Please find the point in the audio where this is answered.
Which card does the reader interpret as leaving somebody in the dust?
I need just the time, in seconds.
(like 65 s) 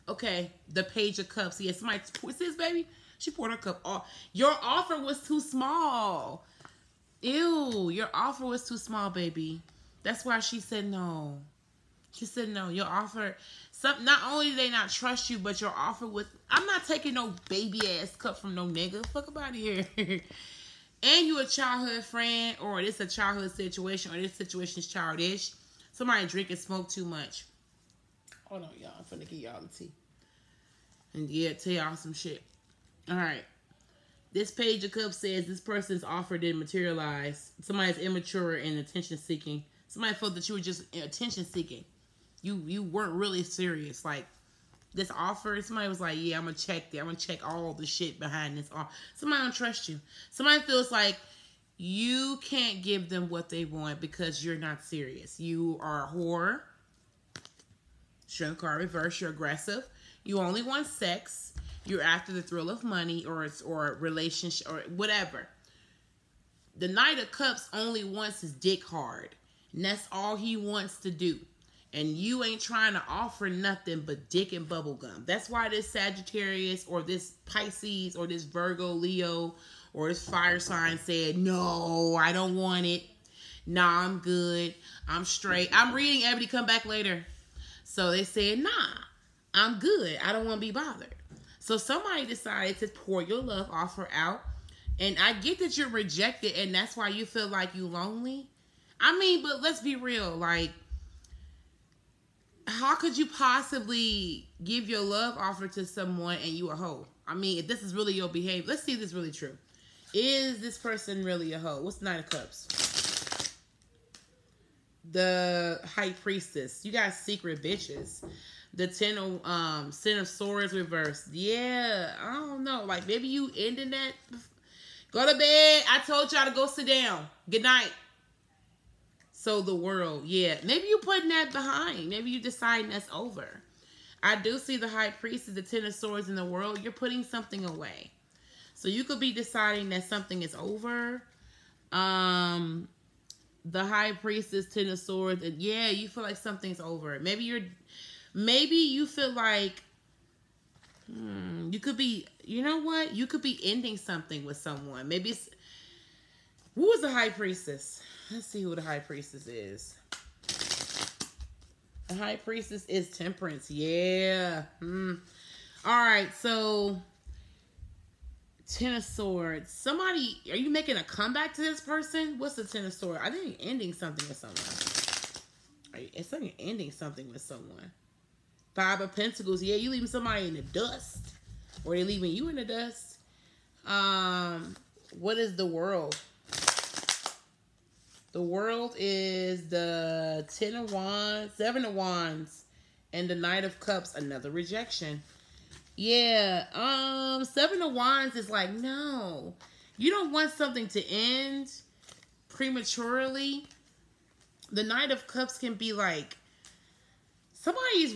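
178 s.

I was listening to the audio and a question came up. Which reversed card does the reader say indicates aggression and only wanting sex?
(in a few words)
Strength.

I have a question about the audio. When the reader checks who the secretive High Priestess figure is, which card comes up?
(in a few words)
Temperance.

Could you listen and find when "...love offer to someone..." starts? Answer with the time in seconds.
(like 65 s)
105 s.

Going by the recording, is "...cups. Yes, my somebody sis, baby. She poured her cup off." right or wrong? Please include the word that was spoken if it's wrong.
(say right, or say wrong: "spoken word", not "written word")
right.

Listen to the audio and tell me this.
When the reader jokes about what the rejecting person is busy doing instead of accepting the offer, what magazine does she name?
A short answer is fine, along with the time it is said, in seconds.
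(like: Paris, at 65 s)
Ebony, at 86 s.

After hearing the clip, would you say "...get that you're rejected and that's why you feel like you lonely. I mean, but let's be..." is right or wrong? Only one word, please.
right.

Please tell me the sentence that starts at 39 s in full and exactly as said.
Somebody felt that you were just attention seeking.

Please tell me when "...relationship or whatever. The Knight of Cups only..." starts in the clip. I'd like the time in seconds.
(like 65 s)
64 s.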